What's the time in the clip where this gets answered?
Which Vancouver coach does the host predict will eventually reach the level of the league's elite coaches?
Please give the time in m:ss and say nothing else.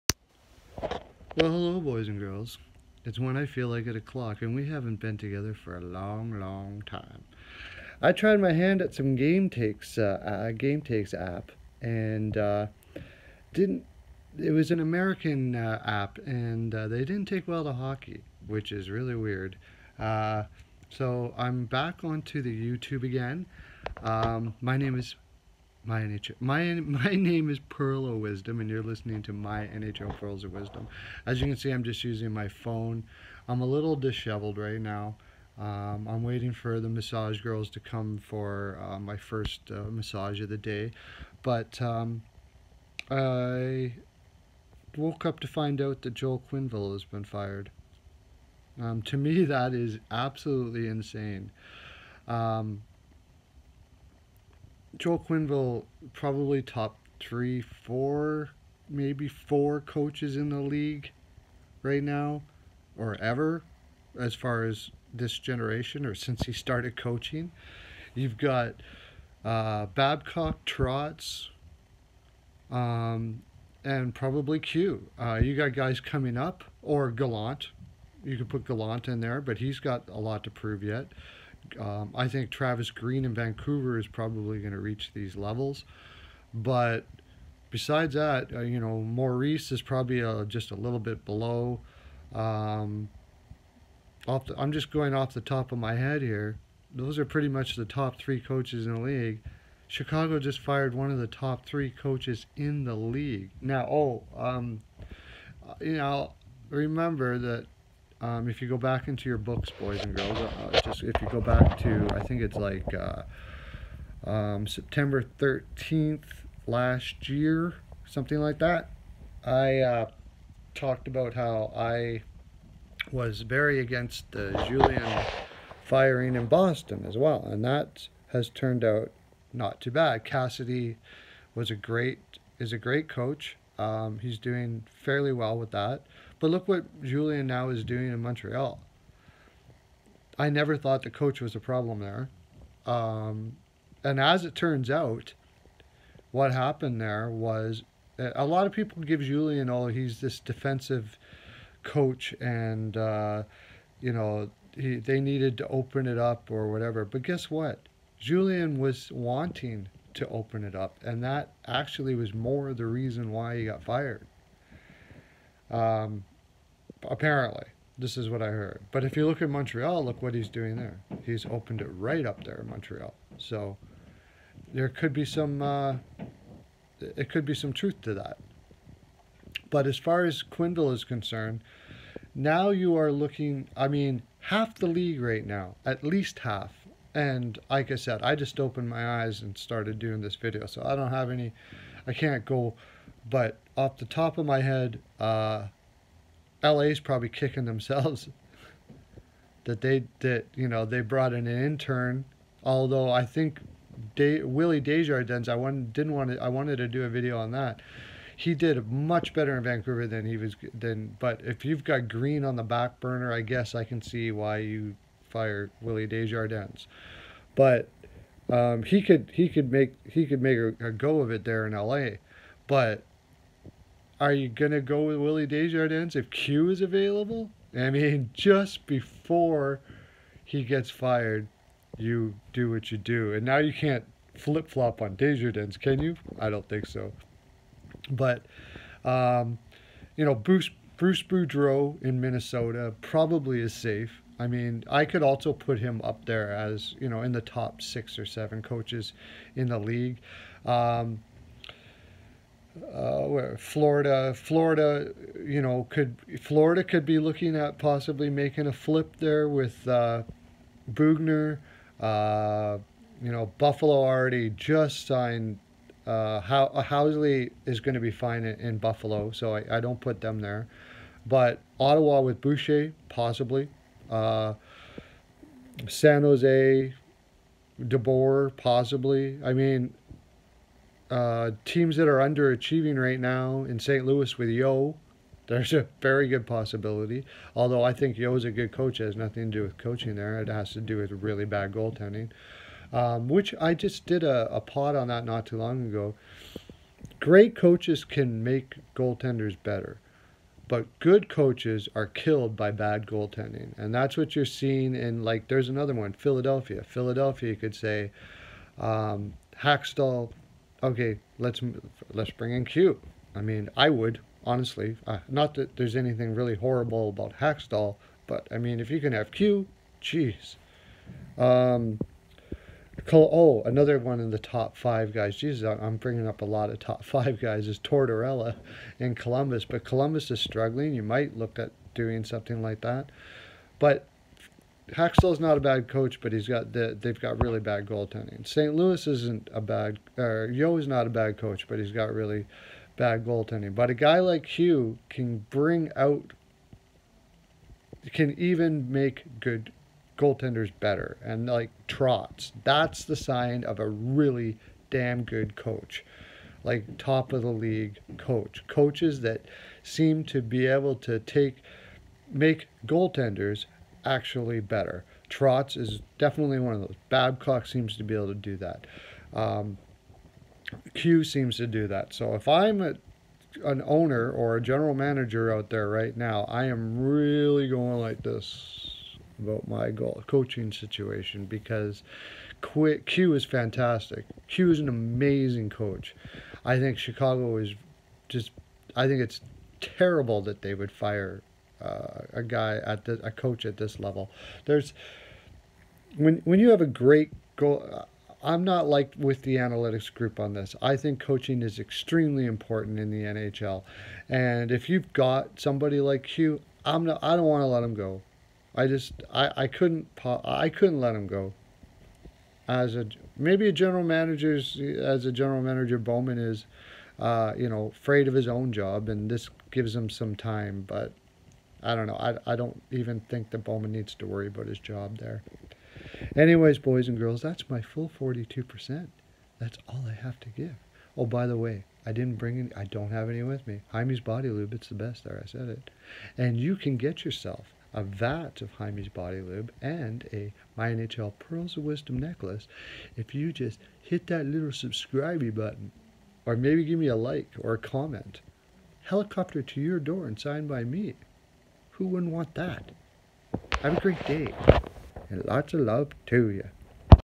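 1:22.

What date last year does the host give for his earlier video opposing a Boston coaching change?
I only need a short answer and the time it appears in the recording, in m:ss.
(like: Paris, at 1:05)
September 13th, at 1:54.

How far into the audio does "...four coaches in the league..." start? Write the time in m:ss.
0:59.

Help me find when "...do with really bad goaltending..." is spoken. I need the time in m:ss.
4:50.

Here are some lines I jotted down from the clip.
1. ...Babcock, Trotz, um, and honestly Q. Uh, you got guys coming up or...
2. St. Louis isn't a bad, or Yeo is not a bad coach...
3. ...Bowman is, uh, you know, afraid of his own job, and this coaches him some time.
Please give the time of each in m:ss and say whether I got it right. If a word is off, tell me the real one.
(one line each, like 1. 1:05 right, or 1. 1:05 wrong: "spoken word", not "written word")
1. 1:09 wrong: "probably", not "honestly"
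2. 5:38 right
3. 6:55 wrong: "gives", not "coaches".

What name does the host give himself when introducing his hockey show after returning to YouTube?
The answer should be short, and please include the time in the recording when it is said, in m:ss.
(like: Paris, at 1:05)
Pearl of Wisdom, at 0:27.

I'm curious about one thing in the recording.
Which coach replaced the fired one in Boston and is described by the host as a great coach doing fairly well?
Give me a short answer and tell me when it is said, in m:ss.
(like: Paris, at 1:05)
Cassidy, at 2:10.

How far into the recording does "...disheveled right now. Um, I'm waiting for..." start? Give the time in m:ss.
0:33.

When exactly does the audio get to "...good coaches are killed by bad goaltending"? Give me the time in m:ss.
5:00.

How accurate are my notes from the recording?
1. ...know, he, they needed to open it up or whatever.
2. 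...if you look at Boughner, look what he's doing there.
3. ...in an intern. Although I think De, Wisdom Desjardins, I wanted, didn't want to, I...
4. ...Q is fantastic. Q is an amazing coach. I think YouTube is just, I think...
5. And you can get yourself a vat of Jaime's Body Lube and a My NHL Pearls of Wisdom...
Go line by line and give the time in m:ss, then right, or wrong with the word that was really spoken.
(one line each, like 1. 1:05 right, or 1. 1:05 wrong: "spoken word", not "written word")
1. 2:34 right
2. 2:49 wrong: "Montreal", not "Boughner"
3. 3:21 wrong: "Willie", not "Wisdom"
4. 6:23 wrong: "Chicago", not "YouTube"
5. 7:16 right.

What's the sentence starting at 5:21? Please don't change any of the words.
Um, oh, another one in the top five guys.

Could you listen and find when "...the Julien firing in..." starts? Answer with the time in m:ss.
2:04.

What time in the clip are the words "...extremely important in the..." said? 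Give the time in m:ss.
6:41.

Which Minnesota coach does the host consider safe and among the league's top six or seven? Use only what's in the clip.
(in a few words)
Bruce Boudreau.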